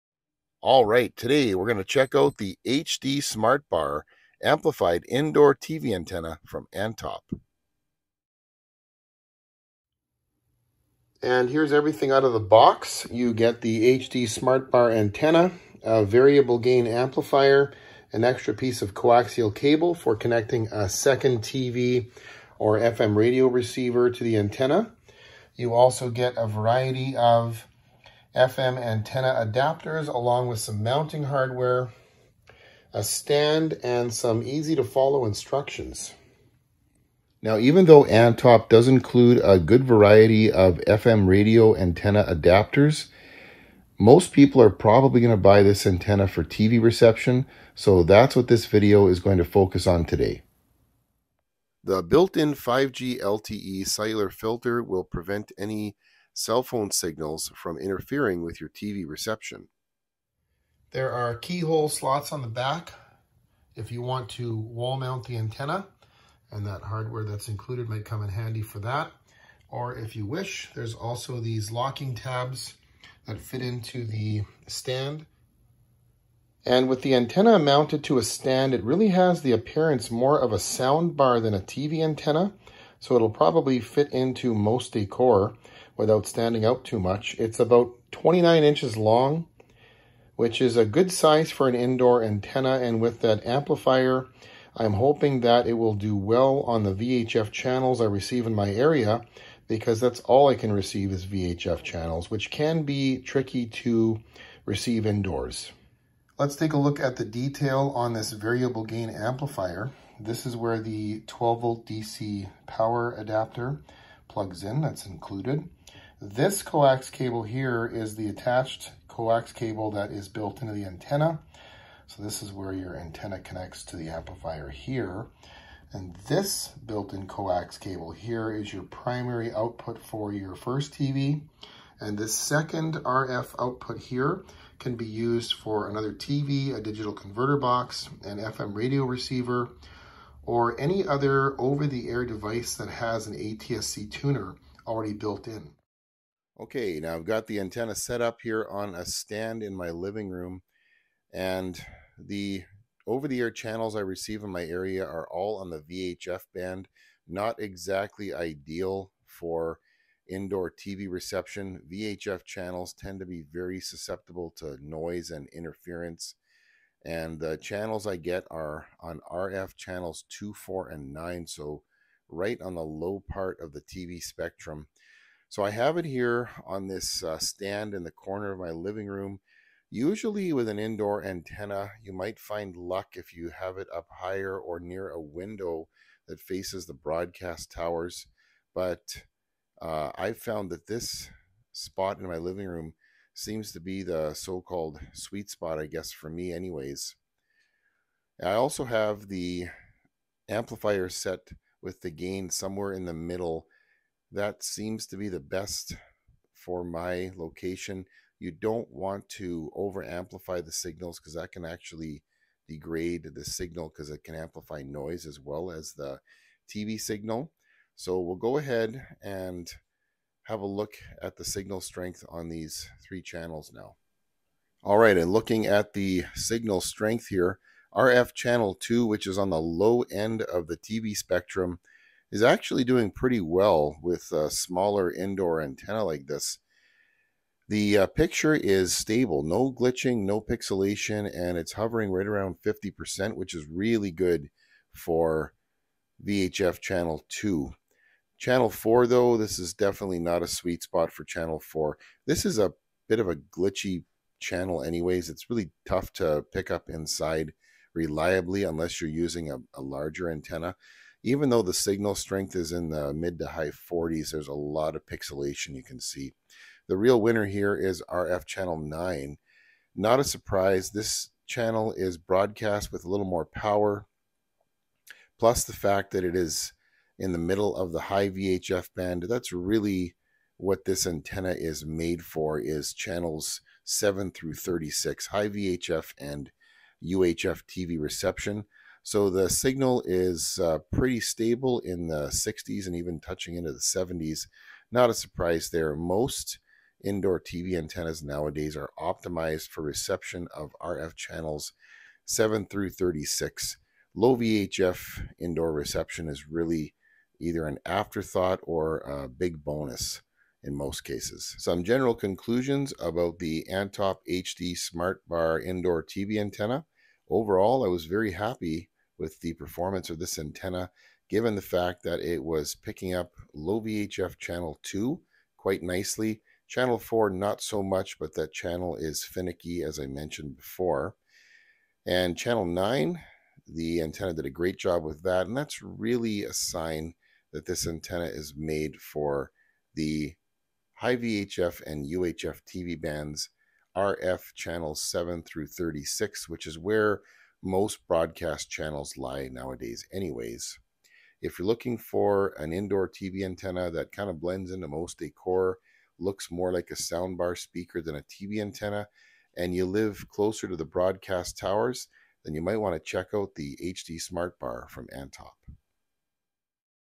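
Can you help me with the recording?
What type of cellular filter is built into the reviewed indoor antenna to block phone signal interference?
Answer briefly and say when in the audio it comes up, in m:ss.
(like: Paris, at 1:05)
5G LTE, at 0:52.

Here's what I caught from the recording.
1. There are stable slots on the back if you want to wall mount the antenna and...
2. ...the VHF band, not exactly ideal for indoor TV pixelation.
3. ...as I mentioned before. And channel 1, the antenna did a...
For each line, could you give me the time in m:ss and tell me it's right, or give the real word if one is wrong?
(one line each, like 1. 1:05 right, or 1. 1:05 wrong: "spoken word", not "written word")
1. 1:00 wrong: "keyhole", not "stable"
2. 2:35 wrong: "reception", not "pixelation"
3. 5:29 wrong: "9", not "1".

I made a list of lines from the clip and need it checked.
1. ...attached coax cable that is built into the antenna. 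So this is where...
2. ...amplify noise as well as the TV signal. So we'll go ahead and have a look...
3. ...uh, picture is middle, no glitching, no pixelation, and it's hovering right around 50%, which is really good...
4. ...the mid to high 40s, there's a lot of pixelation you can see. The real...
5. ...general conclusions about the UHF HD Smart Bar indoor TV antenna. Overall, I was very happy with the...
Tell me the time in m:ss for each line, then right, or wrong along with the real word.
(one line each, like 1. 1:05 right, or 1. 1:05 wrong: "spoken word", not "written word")
1. 1:58 right
2. 3:34 right
3. 3:57 wrong: "stable", not "middle"
4. 4:22 right
5. 5:11 wrong: "Antop", not "UHF".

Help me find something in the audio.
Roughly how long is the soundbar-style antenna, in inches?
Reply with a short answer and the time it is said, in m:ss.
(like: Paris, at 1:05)
29, at 1:28.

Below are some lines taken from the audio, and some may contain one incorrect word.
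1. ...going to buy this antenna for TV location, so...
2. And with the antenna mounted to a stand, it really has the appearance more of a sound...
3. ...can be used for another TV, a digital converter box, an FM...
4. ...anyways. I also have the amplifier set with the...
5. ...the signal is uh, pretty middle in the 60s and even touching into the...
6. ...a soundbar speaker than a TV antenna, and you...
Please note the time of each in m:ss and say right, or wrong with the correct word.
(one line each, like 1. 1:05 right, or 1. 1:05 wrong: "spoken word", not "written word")
1. 0:45 wrong: "reception", not "location"
2. 1:16 right
3. 2:14 right
4. 3:16 right
5. 4:49 wrong: "stable", not "middle"
6. 5:56 right.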